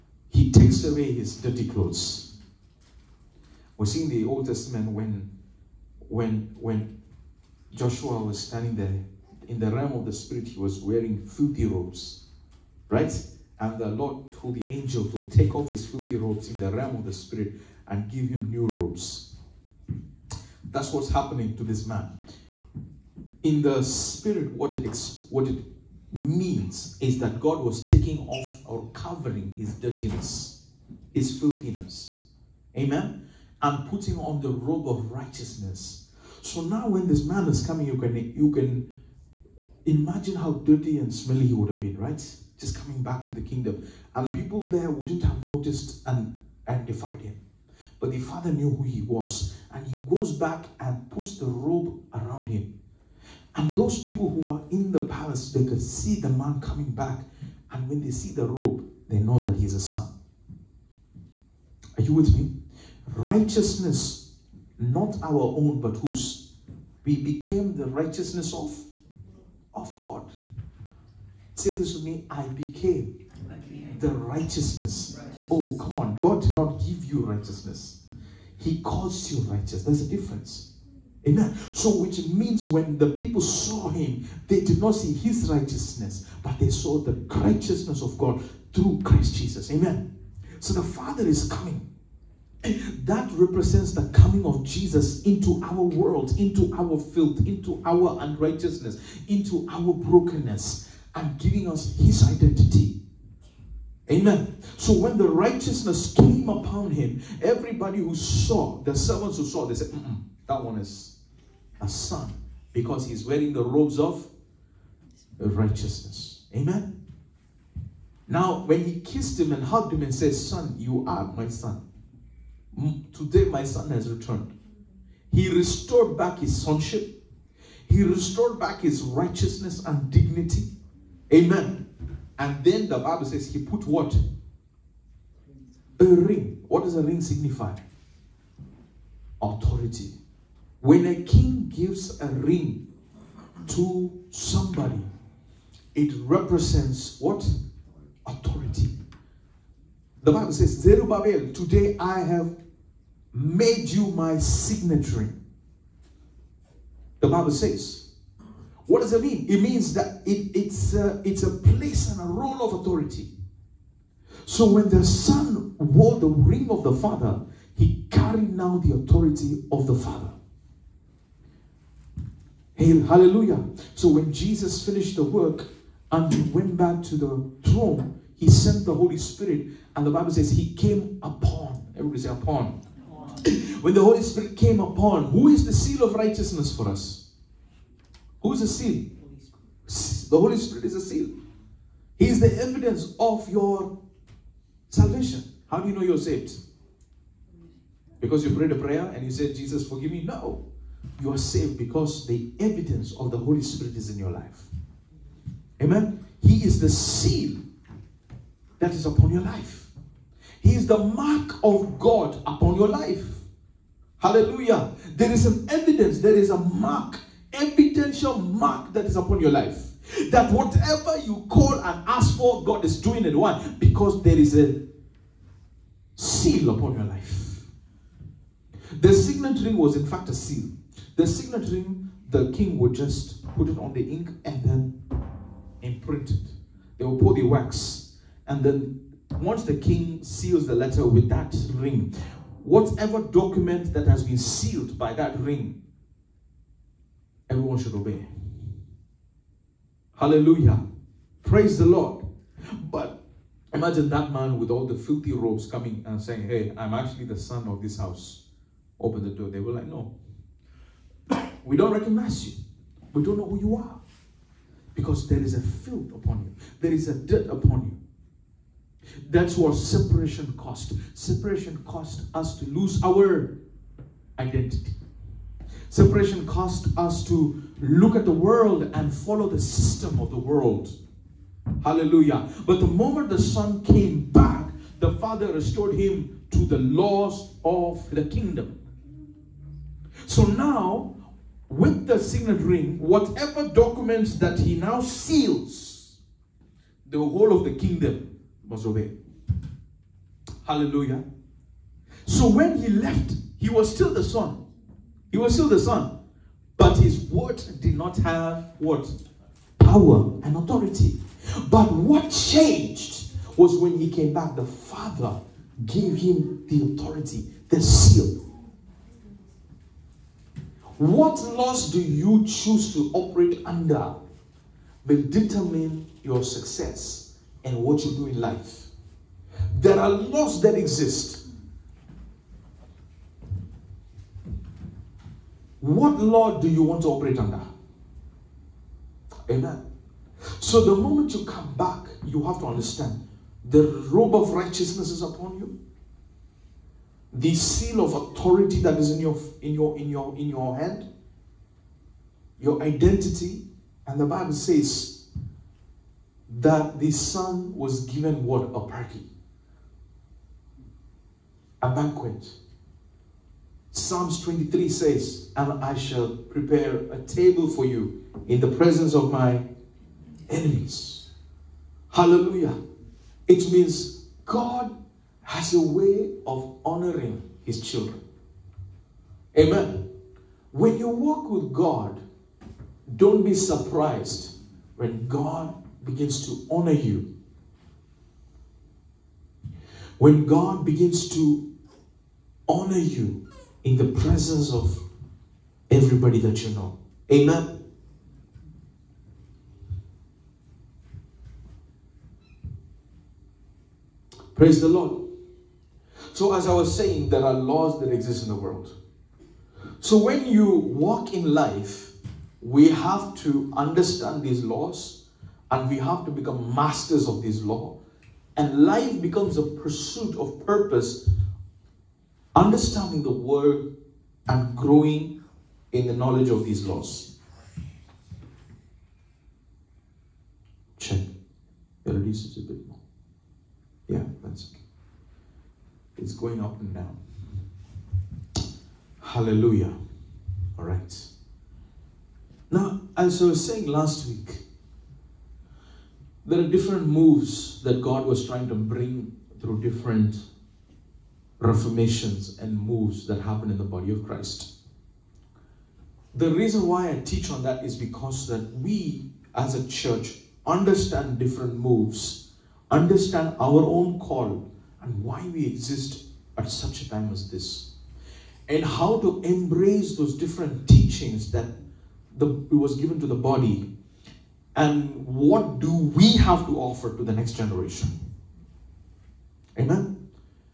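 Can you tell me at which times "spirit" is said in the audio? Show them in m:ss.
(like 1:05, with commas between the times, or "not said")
0:10, 0:17, 0:23, 2:59, 3:04, 3:10, 3:23.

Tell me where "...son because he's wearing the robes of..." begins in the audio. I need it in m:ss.
1:51.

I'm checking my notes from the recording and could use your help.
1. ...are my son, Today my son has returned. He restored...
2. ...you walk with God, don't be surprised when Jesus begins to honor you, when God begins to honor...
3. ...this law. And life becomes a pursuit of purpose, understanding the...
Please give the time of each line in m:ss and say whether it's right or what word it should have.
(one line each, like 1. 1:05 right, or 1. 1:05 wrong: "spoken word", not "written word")
1. 2:01 right
2. 6:20 wrong: "God", not "Jesus"
3. 6:57 right.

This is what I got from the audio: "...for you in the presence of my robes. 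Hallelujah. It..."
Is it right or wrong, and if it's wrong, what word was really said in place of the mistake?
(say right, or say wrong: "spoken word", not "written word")
wrong: "enemies", not "robes".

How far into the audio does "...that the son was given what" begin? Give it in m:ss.
5:56.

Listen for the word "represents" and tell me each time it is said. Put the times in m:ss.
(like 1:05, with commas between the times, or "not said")
1:33, 2:26.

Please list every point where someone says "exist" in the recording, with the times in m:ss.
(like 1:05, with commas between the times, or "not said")
5:30, 6:48, 7:45.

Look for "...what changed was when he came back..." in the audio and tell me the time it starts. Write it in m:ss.
5:11.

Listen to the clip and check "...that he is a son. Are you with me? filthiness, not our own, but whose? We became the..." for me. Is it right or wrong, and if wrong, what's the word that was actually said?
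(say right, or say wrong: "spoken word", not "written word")
wrong: "righteousness", not "filthiness".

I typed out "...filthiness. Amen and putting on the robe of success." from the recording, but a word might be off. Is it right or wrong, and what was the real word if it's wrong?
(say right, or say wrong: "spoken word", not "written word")
wrong: "righteousness", not "success".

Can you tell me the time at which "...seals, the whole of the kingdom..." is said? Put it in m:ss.
4:55.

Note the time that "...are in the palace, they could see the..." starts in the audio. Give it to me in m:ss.
0:54.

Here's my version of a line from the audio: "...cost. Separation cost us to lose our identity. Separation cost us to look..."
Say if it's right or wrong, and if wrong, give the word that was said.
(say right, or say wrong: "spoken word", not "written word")
right.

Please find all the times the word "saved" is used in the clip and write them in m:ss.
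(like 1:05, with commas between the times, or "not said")
3:16, 3:21.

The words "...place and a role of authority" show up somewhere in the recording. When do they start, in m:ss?
2:41.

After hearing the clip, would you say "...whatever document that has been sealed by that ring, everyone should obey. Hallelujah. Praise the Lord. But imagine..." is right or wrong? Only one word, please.
right.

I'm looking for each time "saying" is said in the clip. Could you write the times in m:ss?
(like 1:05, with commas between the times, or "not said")
4:16, 6:46, 7:23.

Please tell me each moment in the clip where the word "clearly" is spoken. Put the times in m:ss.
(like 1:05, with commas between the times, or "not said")
not said.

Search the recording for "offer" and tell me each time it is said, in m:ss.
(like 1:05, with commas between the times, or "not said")
7:56.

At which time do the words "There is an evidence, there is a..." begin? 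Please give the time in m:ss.
3:35.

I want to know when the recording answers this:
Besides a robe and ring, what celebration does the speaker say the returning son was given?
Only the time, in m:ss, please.
6:01.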